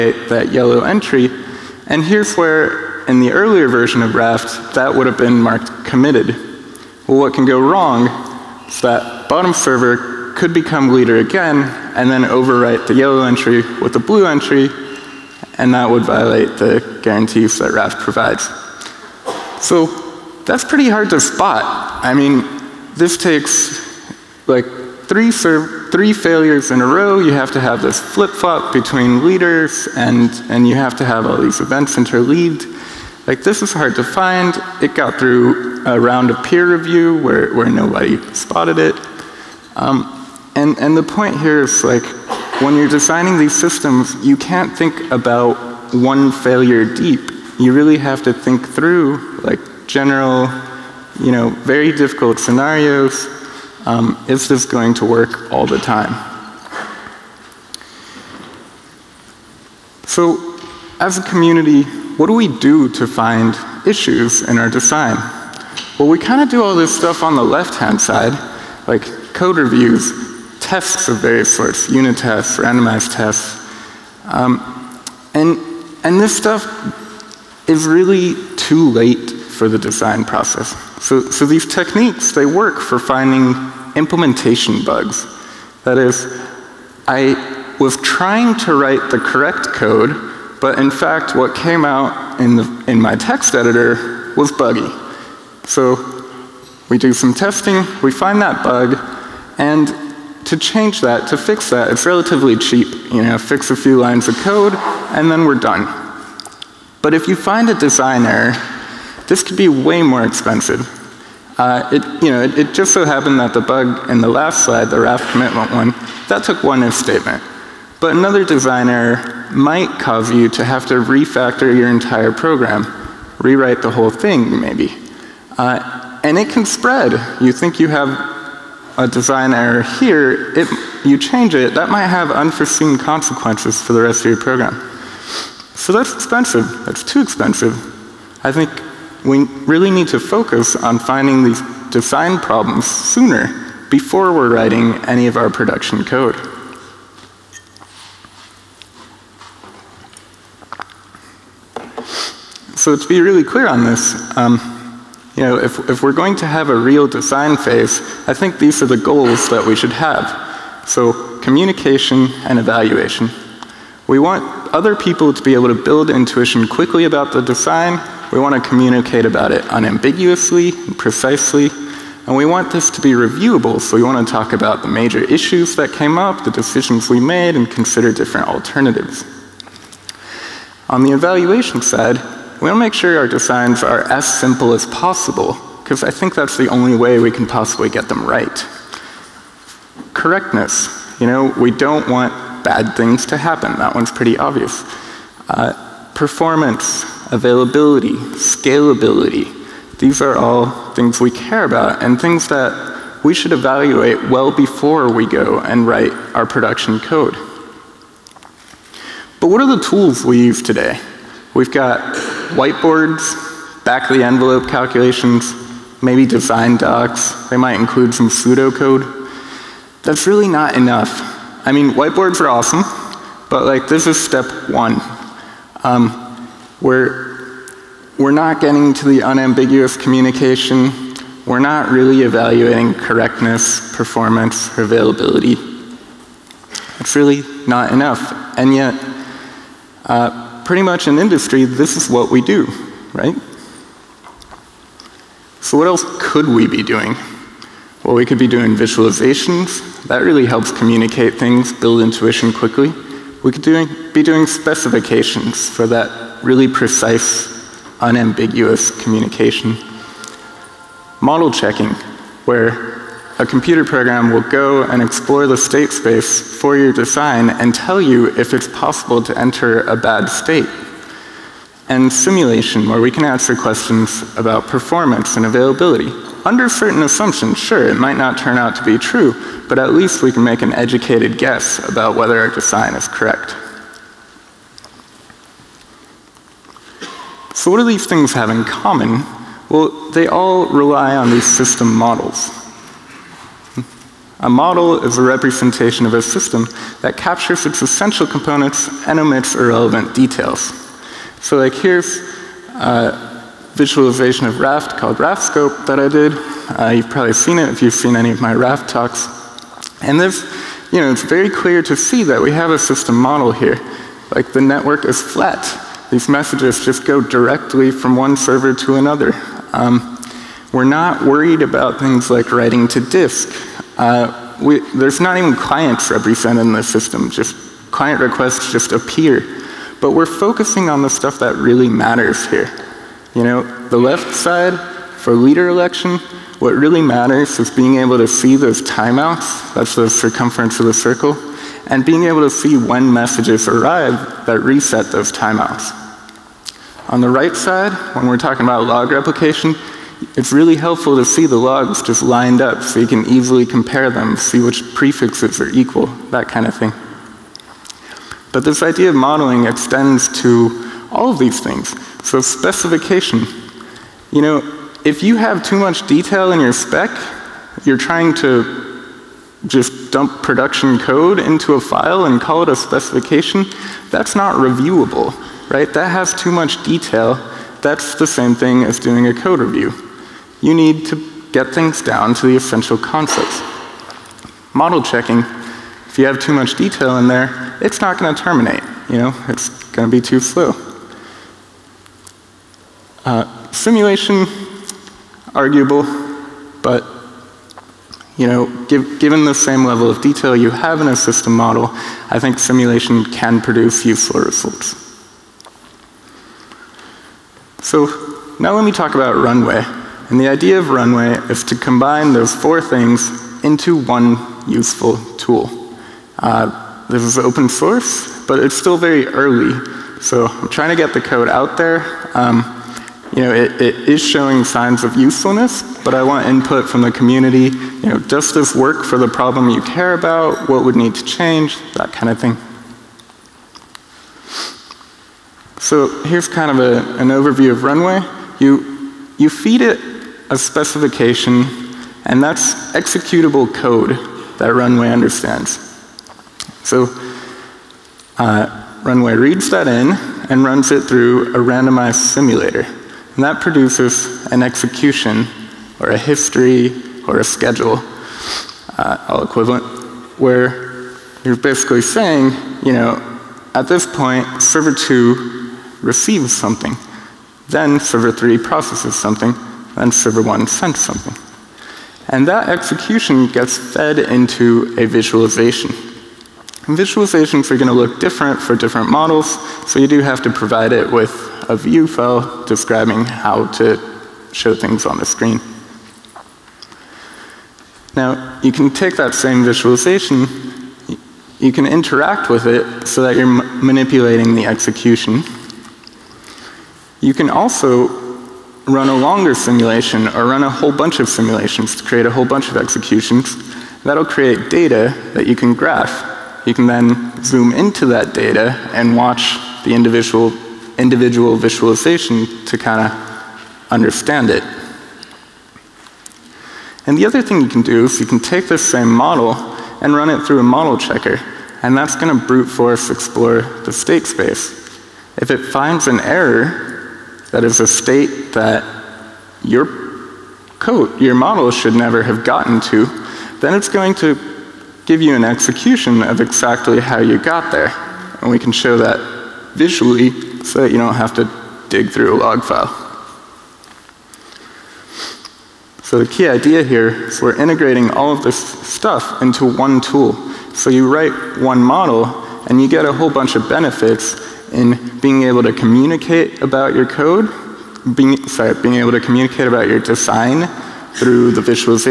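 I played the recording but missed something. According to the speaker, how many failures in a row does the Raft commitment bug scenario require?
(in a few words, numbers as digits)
3.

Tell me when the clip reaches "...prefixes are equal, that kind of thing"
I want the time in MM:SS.
05:54.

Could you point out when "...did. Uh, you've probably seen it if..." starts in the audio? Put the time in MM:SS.
05:06.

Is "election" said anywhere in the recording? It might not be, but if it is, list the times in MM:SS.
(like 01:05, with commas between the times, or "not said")
05:35.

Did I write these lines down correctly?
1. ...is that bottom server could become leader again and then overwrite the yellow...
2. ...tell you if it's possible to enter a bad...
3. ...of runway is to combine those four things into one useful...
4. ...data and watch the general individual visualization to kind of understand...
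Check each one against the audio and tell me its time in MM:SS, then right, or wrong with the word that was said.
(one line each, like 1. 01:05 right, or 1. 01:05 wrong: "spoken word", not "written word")
1. 00:08 right
2. 04:27 right
3. 06:50 right
4. 08:28 wrong: "individual", not "general".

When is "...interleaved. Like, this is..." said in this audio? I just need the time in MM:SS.
00:31.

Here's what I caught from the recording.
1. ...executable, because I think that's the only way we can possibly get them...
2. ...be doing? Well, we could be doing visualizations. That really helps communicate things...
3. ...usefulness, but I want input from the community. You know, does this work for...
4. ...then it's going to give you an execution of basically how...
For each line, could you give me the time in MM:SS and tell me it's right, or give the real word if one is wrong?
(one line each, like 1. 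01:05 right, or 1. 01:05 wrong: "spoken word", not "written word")
1. 03:04 wrong: "possible", not "executable"
2. 04:06 right
3. 07:05 right
4. 08:53 wrong: "exactly", not "basically".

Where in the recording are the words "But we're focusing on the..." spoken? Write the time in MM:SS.
05:30.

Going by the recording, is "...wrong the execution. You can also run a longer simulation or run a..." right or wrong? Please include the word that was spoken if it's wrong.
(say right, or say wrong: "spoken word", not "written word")
wrong: "manipulating", not "wrong".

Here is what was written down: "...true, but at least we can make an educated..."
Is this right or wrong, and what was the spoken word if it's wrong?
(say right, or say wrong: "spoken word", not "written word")
right.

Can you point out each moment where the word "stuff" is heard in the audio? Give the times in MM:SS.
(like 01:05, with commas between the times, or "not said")
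01:06, 01:16, 05:31, 09:08.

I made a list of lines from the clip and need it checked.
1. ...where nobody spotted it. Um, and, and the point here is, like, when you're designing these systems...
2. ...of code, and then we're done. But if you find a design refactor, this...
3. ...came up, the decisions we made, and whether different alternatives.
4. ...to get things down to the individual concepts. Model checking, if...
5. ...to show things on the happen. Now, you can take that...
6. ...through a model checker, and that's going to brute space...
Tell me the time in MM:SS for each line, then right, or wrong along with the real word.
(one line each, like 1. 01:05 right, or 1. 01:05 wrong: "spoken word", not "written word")
1. 00:37 right
2. 01:44 wrong: "error", not "refactor"
3. 02:55 wrong: "consider", not "whether"
4. 06:21 wrong: "essential", not "individual"
5. 08:03 wrong: "screen", not "happen"
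6. 08:40 wrong: "force", not "space".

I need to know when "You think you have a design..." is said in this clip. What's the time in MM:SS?
02:07.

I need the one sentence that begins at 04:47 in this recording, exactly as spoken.
So what do these things have in common?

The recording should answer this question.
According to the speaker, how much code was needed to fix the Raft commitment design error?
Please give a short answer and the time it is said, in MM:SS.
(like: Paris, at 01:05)
one if statement, at 01:56.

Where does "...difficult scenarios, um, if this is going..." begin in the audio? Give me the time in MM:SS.
00:51.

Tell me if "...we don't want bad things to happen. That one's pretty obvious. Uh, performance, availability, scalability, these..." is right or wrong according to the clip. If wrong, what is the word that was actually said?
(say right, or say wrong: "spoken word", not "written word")
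right.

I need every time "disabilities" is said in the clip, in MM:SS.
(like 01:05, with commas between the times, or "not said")
not said.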